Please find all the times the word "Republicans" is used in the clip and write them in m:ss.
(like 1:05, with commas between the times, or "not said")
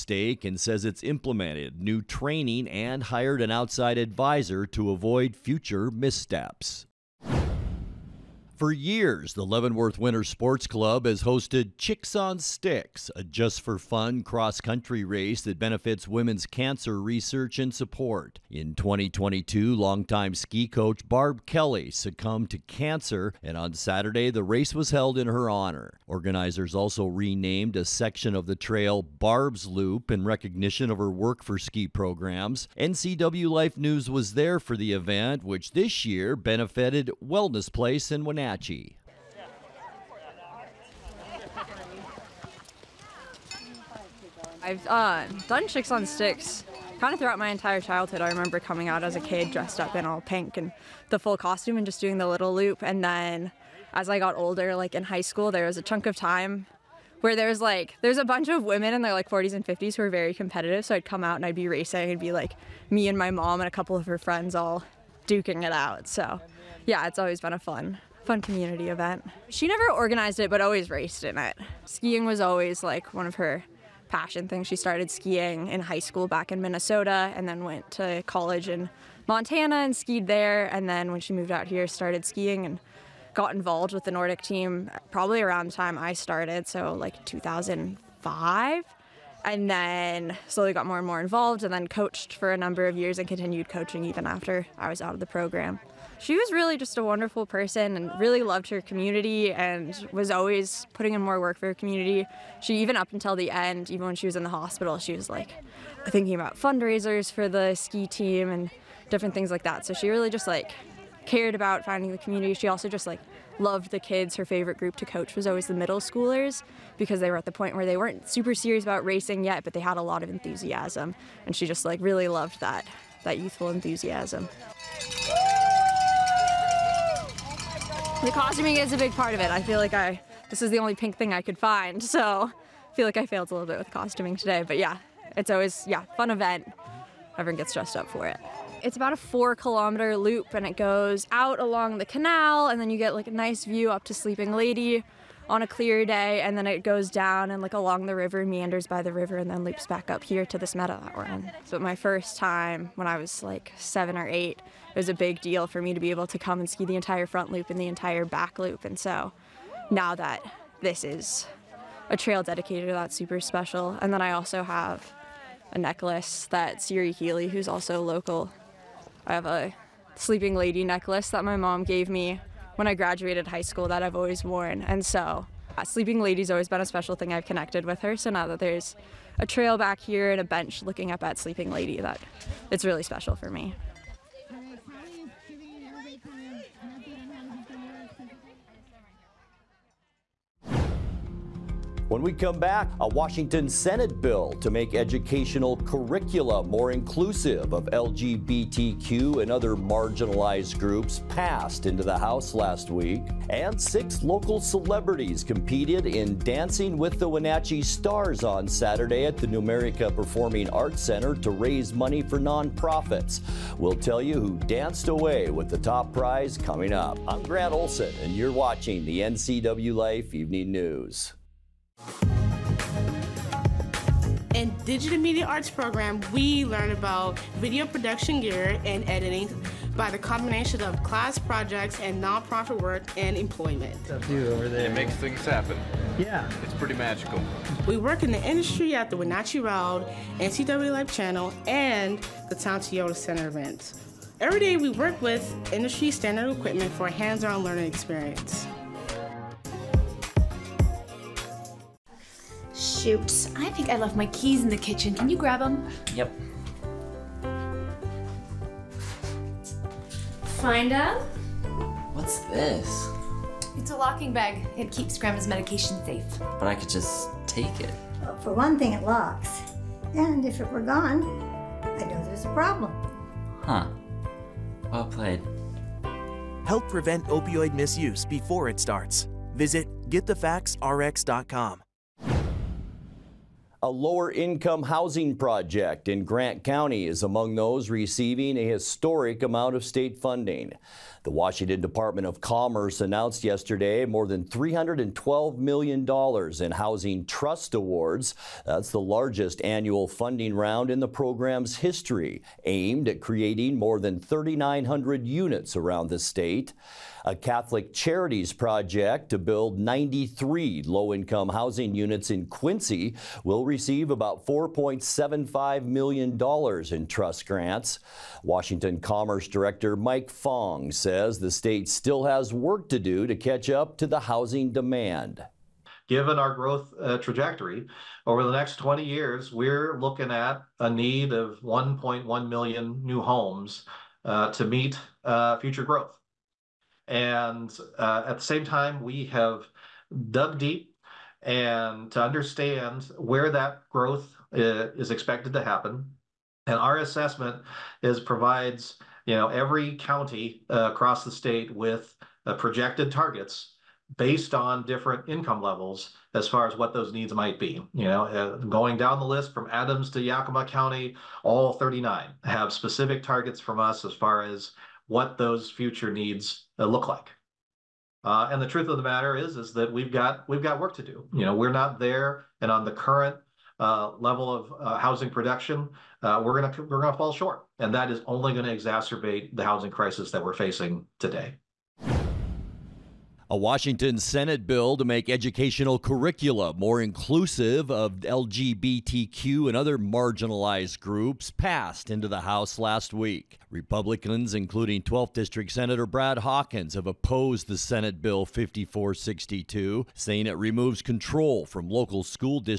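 6:33.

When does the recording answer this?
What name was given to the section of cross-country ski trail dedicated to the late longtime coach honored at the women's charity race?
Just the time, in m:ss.
0:29.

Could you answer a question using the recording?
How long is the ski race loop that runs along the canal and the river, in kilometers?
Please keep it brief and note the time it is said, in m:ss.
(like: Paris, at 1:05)
4 kilometers, at 2:19.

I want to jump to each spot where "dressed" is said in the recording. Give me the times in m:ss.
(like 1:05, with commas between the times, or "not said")
0:49, 2:17.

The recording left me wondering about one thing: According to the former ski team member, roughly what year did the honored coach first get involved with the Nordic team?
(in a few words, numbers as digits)
2005.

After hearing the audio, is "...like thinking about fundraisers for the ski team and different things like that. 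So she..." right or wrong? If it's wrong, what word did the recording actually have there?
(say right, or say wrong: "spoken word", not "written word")
right.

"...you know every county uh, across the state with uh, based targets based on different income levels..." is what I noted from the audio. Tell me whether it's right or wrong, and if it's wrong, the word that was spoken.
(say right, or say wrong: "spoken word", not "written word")
wrong: "projected", not "based".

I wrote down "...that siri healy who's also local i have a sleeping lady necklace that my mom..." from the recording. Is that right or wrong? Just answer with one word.
right.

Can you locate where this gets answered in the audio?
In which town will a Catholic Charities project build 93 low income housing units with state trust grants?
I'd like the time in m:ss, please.
5:12.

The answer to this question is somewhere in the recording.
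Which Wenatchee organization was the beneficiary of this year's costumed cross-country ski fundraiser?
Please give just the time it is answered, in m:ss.
0:37.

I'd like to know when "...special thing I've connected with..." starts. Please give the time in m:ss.
2:56.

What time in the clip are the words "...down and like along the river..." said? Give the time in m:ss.
2:27.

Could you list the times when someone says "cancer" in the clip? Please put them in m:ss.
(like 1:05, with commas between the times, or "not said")
0:16, 0:22.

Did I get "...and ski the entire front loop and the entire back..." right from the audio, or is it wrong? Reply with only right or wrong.
right.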